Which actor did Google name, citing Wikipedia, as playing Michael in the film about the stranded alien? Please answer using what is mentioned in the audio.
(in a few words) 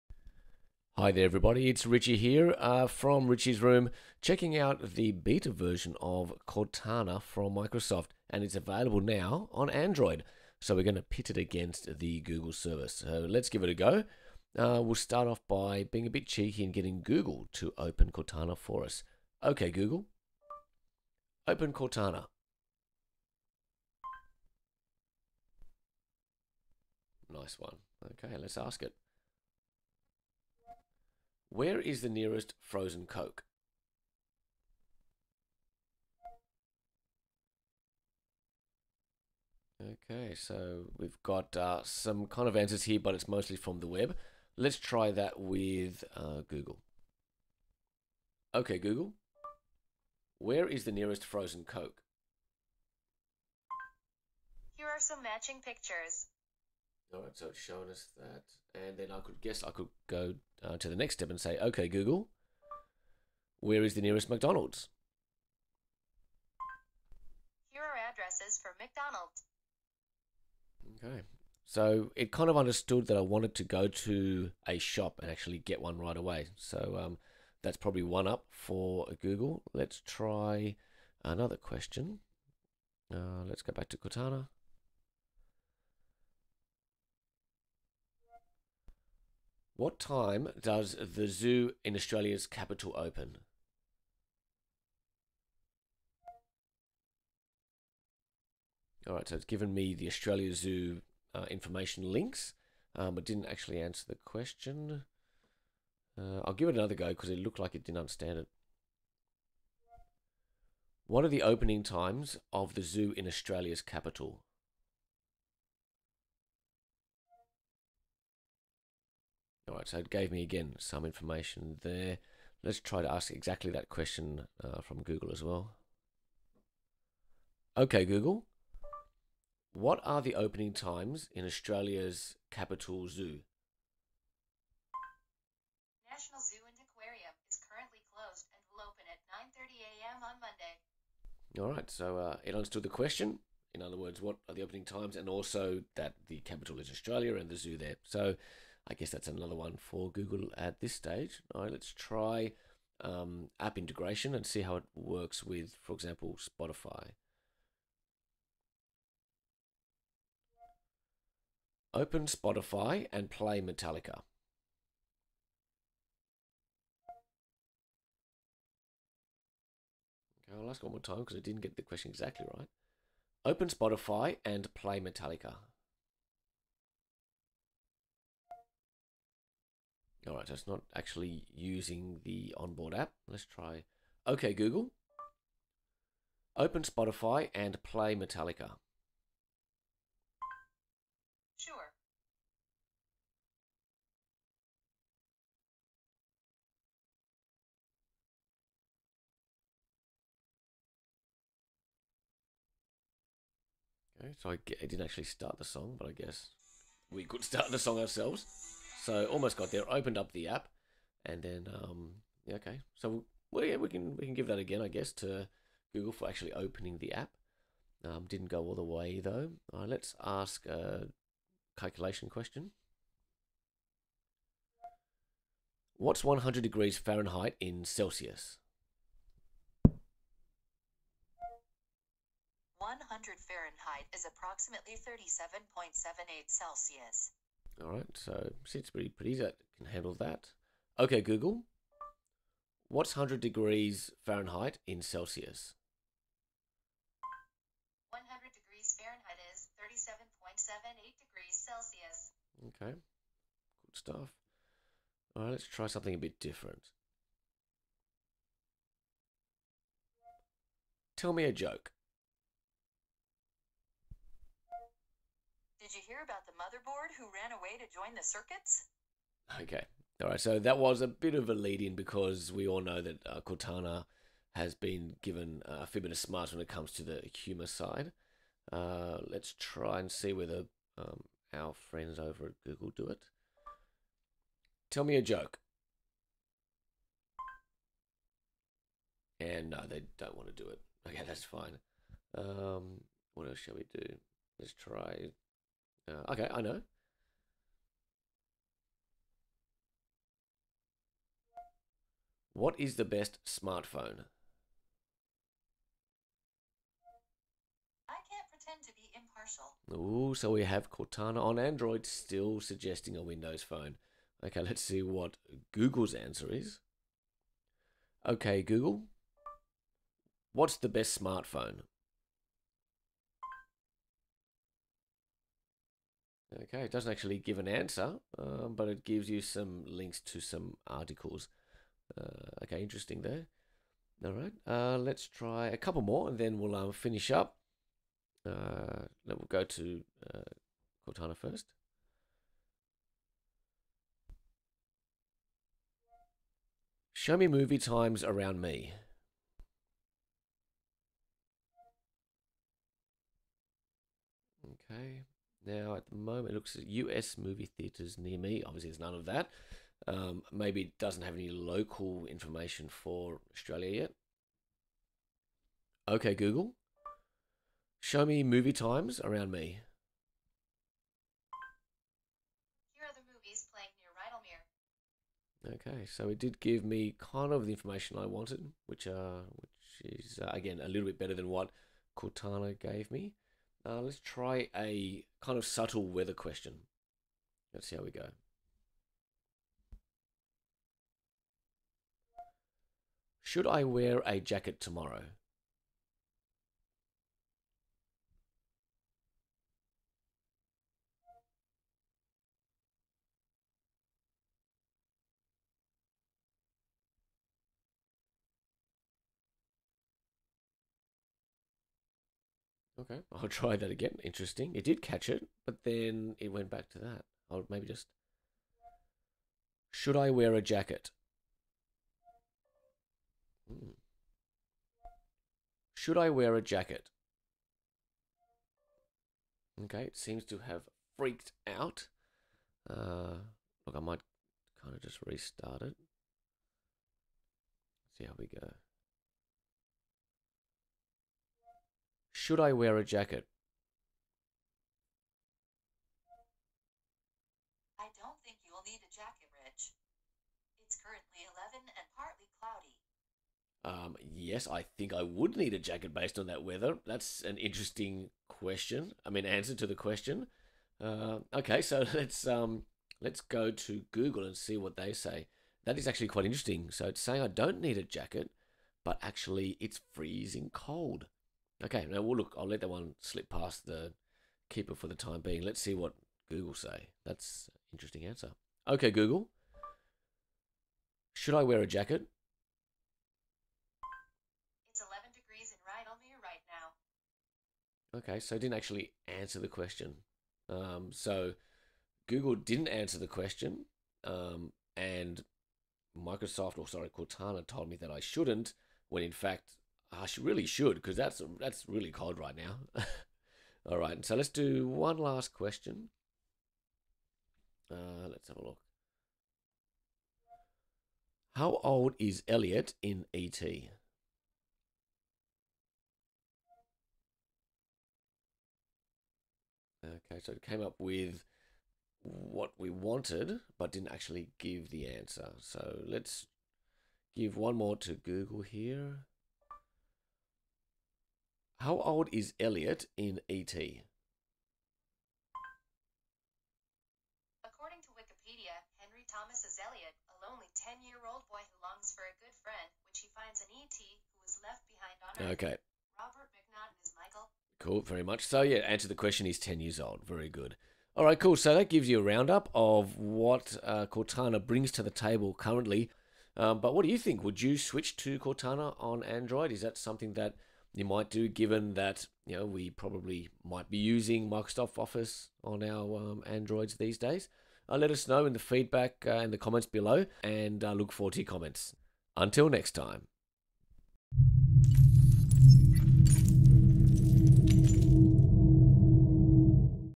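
Robert MacNaughton.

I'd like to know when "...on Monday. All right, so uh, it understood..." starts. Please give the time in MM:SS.
02:20.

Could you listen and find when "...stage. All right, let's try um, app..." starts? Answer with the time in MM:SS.
02:30.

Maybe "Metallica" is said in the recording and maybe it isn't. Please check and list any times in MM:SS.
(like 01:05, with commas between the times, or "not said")
02:43, 02:55, 03:08.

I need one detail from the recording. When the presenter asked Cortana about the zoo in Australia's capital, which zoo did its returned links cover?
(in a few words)
Australia Zoo.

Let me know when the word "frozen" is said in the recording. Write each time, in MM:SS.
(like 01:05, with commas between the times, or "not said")
00:32, 00:51.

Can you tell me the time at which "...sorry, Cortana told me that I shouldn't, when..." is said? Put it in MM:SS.
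08:16.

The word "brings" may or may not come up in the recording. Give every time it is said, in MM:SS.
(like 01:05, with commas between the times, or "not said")
09:14.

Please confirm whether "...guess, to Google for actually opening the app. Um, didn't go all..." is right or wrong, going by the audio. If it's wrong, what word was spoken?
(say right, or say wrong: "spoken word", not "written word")
right.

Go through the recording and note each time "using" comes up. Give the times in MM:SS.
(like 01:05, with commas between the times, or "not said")
03:01, 09:23.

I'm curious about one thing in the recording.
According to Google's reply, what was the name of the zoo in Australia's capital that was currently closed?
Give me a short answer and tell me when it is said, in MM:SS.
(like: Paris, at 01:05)
National Zoo and Aquarium, at 02:16.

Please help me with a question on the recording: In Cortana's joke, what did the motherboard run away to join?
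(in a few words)
the circuits.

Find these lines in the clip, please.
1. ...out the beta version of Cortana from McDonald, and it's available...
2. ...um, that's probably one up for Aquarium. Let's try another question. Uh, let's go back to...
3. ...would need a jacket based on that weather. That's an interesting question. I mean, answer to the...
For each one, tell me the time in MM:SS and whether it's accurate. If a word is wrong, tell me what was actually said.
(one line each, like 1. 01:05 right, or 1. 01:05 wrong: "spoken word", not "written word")
1. 00:04 wrong: "Microsoft", not "McDonald"
2. 01:17 wrong: "Google", not "Aquarium"
3. 07:35 right.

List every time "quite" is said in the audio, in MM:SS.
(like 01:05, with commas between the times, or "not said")
07:46.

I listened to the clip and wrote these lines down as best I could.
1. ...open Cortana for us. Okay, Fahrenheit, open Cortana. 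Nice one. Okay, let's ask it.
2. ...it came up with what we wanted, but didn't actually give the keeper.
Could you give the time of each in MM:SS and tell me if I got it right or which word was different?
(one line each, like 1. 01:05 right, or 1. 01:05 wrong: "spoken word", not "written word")
1. 00:17 wrong: "Google", not "Fahrenheit"
2. 08:40 wrong: "answer", not "keeper".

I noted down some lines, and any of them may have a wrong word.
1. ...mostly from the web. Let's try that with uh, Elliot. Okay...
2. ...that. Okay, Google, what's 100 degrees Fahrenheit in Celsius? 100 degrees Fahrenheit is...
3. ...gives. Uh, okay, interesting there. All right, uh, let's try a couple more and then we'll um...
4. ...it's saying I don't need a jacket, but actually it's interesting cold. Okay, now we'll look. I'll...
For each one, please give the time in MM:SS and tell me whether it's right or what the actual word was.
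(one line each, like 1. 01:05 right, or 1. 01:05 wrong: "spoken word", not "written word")
1. 00:43 wrong: "Google", not "Elliot"
2. 04:00 right
3. 05:30 wrong: "articles", not "gives"
4. 07:47 wrong: "freezing", not "interesting".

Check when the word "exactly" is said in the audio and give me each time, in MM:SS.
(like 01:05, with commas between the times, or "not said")
02:03, 02:52.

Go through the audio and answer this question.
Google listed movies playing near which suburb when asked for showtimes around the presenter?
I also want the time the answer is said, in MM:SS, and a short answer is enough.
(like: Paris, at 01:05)
Rydalmere, at 06:15.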